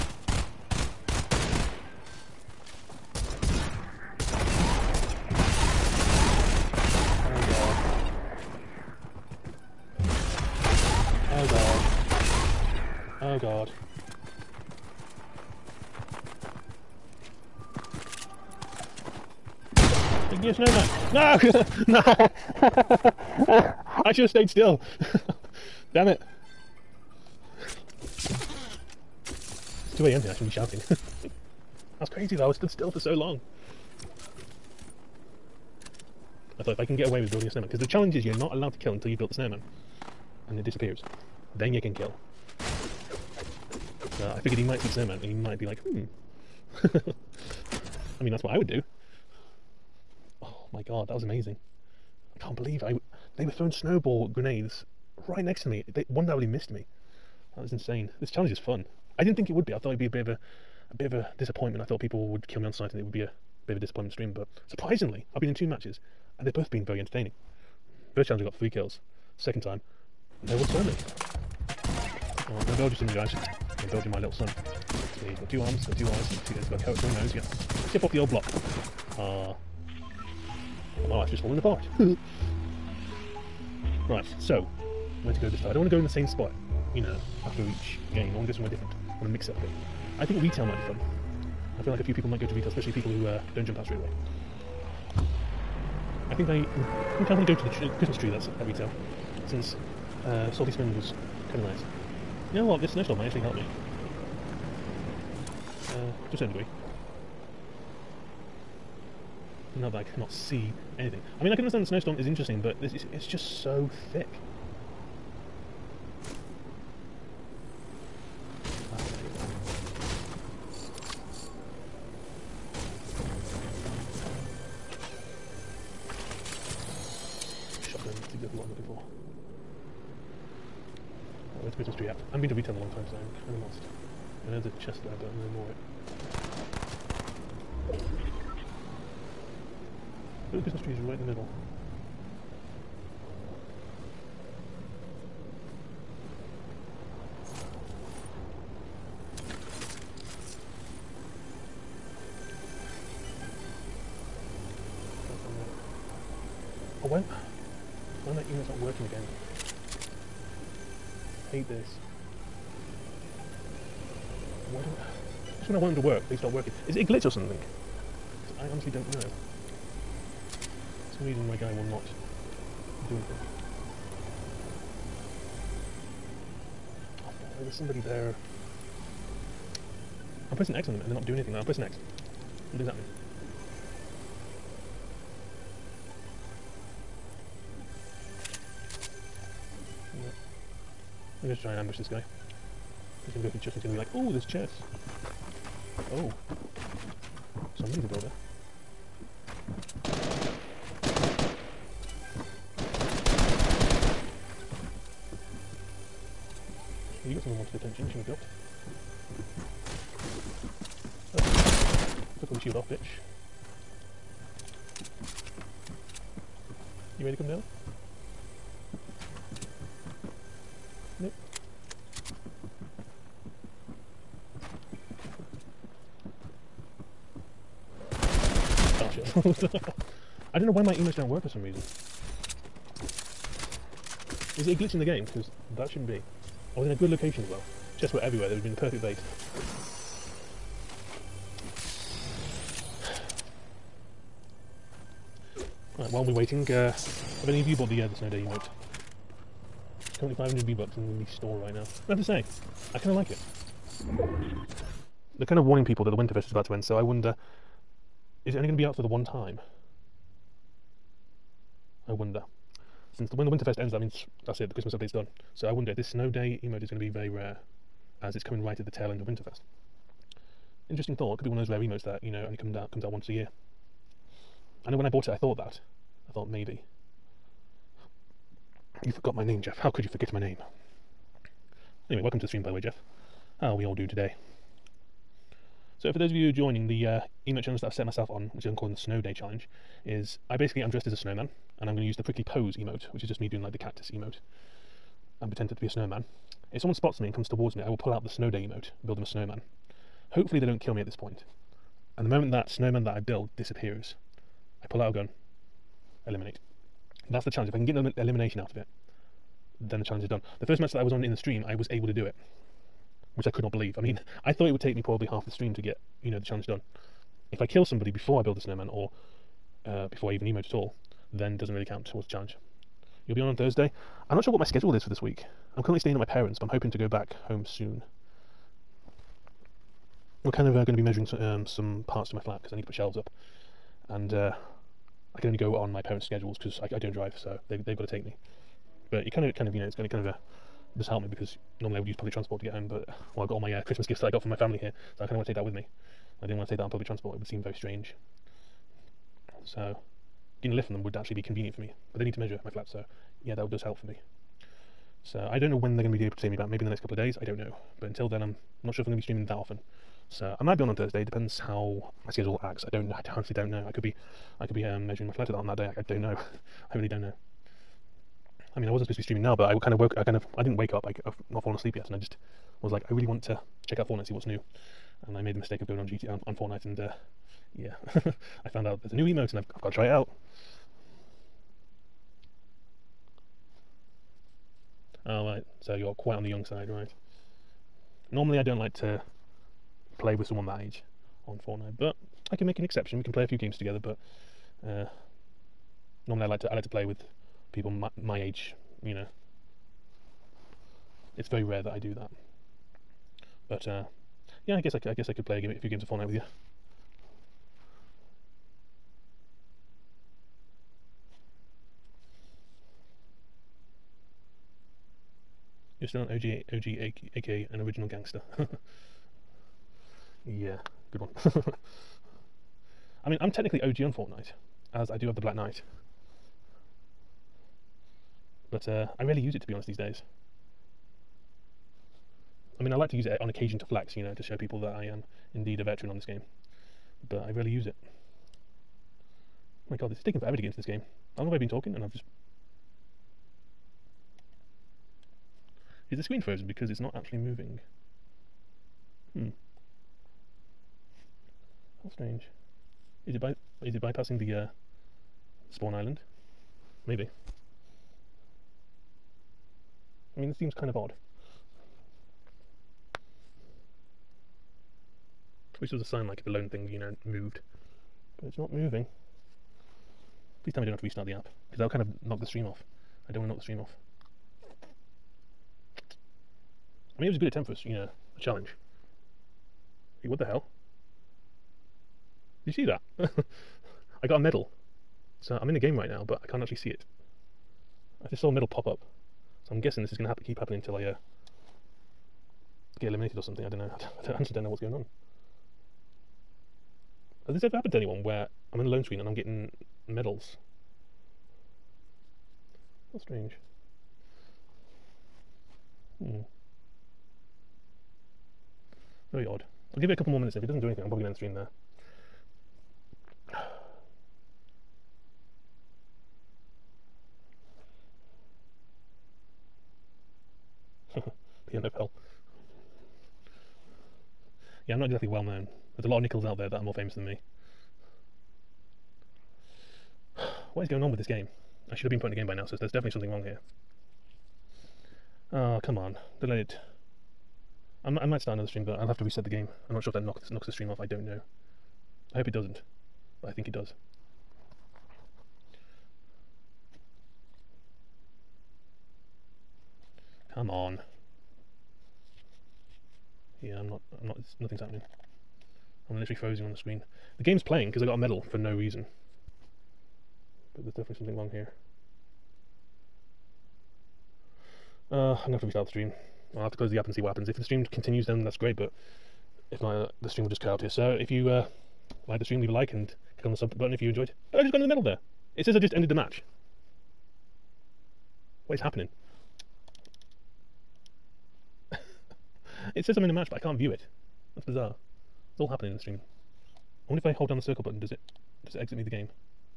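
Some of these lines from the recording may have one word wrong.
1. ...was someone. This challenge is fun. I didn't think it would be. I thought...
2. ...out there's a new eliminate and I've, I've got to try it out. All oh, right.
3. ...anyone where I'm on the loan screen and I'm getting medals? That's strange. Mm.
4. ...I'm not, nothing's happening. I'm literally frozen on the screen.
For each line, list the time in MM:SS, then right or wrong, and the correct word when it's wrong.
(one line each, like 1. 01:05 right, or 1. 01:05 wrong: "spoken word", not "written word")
1. 00:57 wrong: "insane", not "someone"
2. 06:18 wrong: "emote", not "eliminate"
3. 08:17 right
4. 09:14 right.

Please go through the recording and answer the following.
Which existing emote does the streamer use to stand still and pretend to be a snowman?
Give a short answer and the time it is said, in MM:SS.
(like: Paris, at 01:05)
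prickly pose, at 04:52.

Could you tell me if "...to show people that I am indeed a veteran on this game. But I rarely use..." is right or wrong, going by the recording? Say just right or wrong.
right.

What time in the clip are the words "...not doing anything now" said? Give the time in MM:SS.
03:01.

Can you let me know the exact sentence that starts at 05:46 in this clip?
I didn't want to say that on public transport, it would seem very strange.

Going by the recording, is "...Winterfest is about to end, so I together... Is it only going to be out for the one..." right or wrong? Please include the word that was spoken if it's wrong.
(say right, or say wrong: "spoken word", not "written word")
wrong: "wonder", not "together".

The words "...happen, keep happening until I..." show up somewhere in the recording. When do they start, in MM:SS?
08:10.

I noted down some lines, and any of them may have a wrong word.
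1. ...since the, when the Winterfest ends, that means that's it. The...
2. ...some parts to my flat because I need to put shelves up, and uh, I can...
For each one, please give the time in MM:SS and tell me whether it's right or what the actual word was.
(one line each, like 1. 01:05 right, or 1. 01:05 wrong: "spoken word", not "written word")
1. 04:23 right
2. 05:31 right.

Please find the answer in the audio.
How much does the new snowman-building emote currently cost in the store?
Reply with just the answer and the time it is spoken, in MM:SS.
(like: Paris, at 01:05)
500 V-Bucks, at 04:10.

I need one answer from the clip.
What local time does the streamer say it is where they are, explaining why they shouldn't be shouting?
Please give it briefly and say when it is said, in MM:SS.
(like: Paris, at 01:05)
2 a.m., at 00:29.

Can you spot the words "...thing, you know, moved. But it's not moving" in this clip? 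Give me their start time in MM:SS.
07:46.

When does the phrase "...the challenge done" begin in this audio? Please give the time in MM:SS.
05:16.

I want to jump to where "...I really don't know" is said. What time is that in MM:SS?
06:06.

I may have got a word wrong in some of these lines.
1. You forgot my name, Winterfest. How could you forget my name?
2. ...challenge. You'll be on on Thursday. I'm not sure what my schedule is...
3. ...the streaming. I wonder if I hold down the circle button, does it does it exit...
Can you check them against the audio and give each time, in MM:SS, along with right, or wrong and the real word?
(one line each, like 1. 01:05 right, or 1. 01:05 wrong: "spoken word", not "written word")
1. 04:39 wrong: "Jeff", not "Winterfest"
2. 05:22 right
3. 09:45 right.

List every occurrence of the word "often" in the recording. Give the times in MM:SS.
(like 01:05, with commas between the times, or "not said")
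05:59.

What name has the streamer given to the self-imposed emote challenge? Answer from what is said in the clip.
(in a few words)
Snow Day Challenge.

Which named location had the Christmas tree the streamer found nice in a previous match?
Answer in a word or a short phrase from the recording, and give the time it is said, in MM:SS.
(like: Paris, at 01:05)
Salty Springs, at 01:40.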